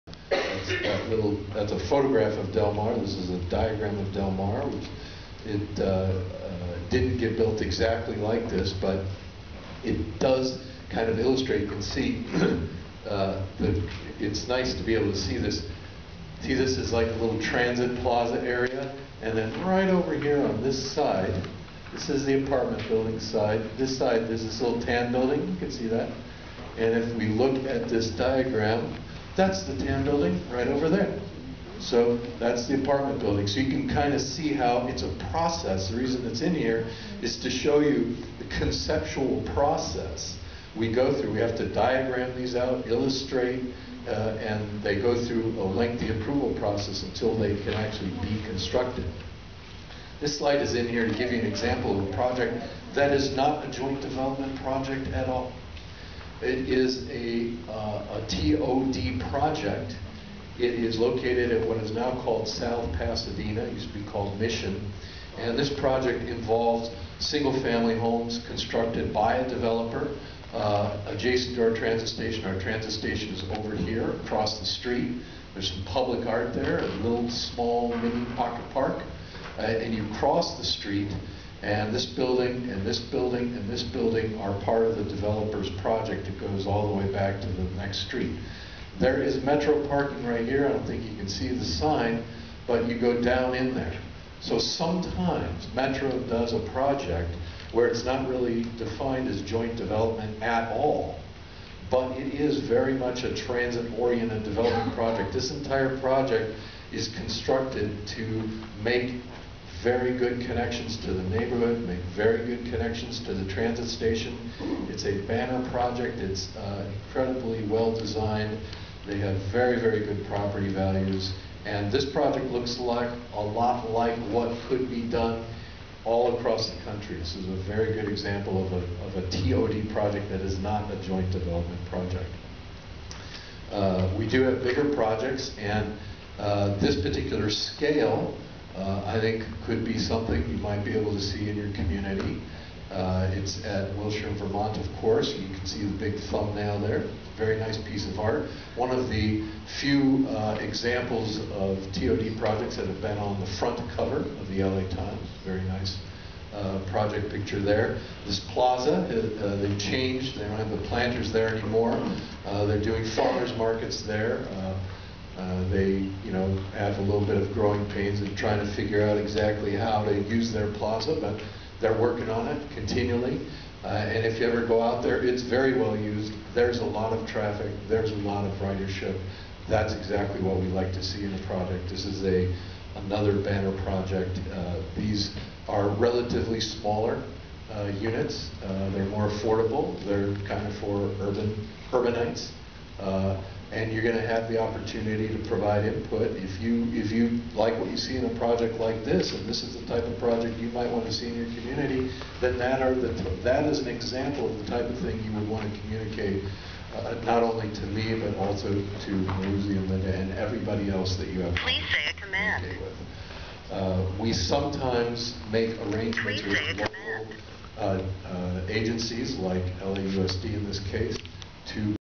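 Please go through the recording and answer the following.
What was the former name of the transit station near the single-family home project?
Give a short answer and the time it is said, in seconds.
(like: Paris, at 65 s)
Mission, at 64 s.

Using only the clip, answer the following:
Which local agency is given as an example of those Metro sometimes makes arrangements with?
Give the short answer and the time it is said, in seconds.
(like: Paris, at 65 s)
LAUSD, at 219 s.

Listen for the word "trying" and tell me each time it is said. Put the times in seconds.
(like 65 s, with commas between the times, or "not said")
168 s.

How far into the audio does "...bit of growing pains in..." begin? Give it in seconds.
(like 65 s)
167 s.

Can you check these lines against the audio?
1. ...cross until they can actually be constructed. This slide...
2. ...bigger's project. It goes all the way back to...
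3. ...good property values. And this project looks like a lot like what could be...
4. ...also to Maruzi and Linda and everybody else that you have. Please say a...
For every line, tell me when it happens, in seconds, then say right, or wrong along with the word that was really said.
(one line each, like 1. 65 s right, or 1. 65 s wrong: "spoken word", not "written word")
1. 46 s wrong: "process", not "cross"
2. 85 s wrong: "developer", not "bigger"
3. 120 s right
4. 208 s right.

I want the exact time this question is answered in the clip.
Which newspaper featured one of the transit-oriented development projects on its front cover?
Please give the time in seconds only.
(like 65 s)
154 s.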